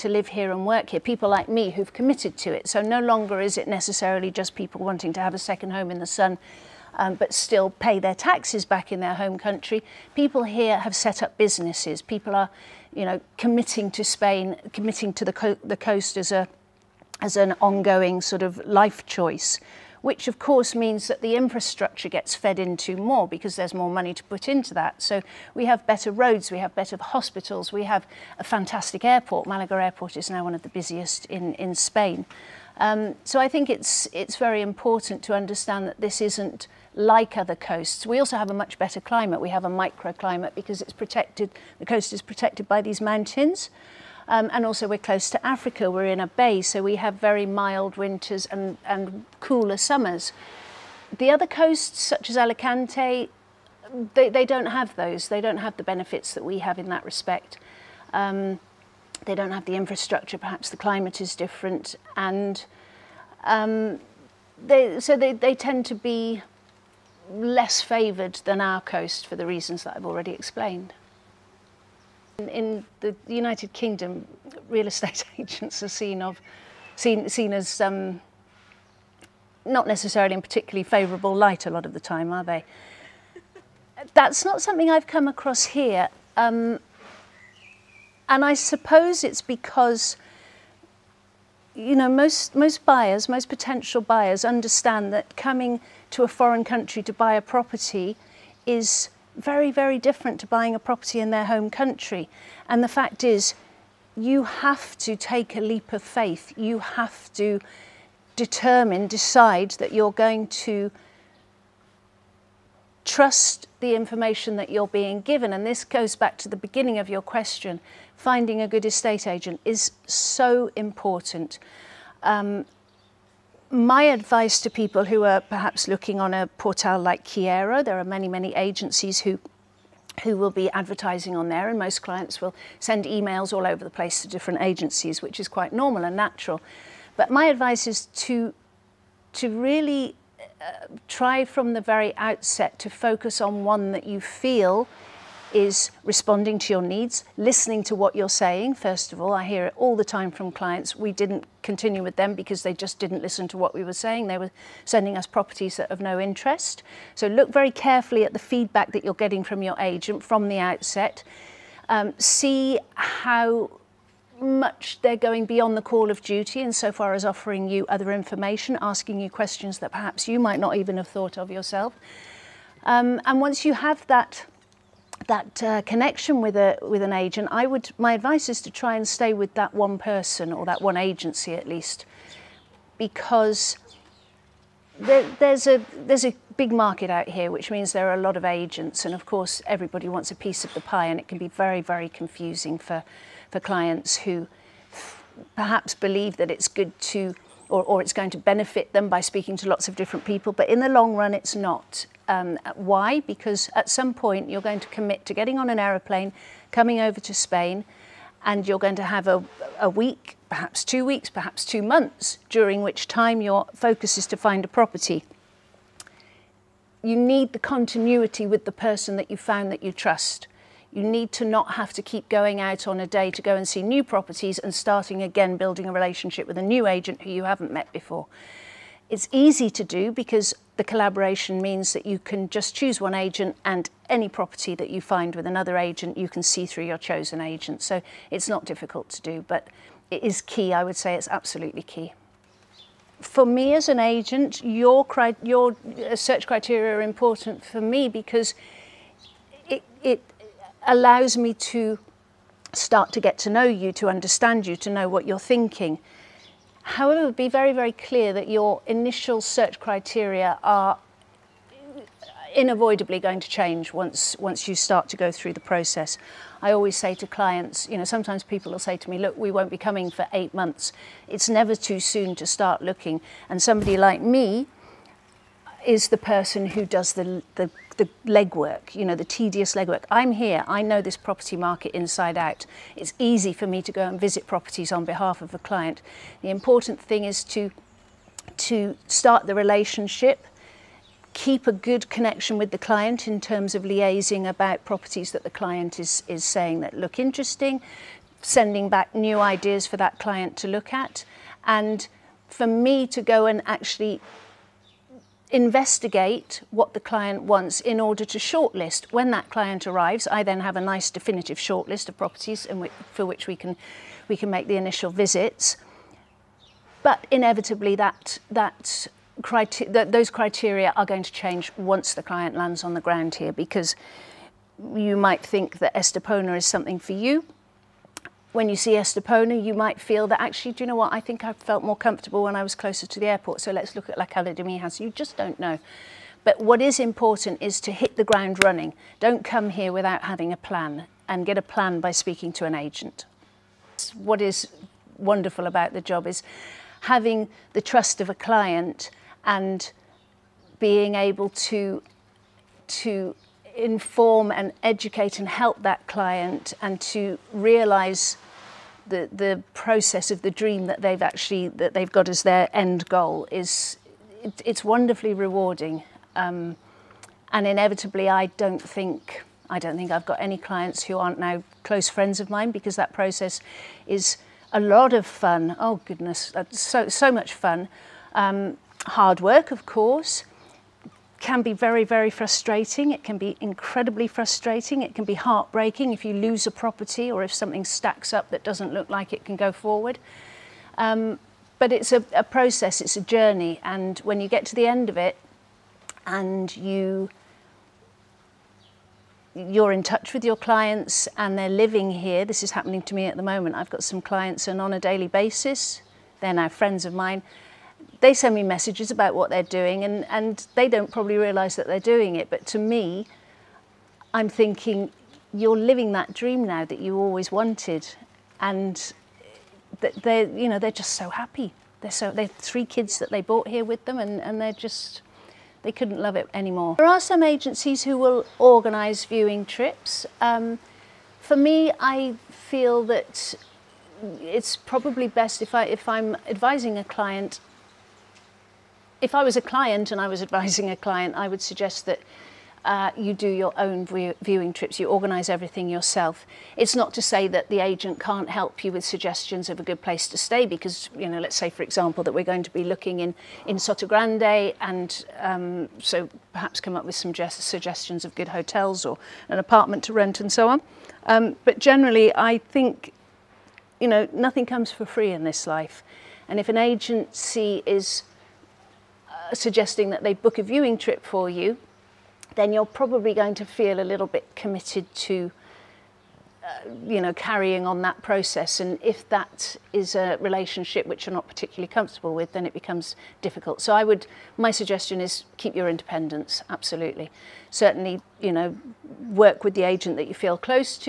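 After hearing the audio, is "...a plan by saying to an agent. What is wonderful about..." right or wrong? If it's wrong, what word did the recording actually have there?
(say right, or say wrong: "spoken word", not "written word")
wrong: "speaking", not "saying".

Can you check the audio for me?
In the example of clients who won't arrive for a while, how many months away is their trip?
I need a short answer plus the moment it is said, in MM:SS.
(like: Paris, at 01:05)
8, at 04:30.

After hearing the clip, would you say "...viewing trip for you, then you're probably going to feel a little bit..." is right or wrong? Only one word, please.
right.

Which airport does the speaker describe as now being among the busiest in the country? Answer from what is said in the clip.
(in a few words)
Malaga Airport.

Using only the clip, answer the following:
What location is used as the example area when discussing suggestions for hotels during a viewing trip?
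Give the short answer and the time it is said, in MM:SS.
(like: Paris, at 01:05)
Sotogrande, at 07:33.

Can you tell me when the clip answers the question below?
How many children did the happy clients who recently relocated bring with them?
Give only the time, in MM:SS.
07:02.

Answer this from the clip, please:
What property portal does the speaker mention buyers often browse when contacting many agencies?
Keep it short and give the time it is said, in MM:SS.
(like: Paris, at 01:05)
Kyero, at 02:07.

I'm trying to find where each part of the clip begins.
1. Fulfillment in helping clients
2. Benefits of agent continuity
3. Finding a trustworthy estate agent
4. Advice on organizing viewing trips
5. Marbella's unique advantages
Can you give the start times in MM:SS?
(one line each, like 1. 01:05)
1. 06:05
2. 04:02
3. 01:57
4. 07:14
5. 01:03.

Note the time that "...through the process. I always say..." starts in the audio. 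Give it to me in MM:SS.
04:25.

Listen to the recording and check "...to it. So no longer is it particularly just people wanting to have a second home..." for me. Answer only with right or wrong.
wrong.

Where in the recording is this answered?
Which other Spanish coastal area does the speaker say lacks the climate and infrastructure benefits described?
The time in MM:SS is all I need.
00:52.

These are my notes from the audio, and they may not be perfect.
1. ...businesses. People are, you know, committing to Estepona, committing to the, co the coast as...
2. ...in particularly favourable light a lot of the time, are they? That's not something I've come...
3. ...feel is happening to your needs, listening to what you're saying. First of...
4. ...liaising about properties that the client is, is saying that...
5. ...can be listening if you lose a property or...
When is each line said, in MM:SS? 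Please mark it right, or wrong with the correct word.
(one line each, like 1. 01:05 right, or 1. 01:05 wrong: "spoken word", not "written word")
1. 00:11 wrong: "Spain", not "Estepona"
2. 01:20 right
3. 02:24 wrong: "responding", not "happening"
4. 04:53 right
5. 06:25 wrong: "heartbreaking", not "listening".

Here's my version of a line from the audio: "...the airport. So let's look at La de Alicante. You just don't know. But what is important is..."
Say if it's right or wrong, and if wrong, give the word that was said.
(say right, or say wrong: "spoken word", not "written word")
wrong: "Mijas", not "Alicante".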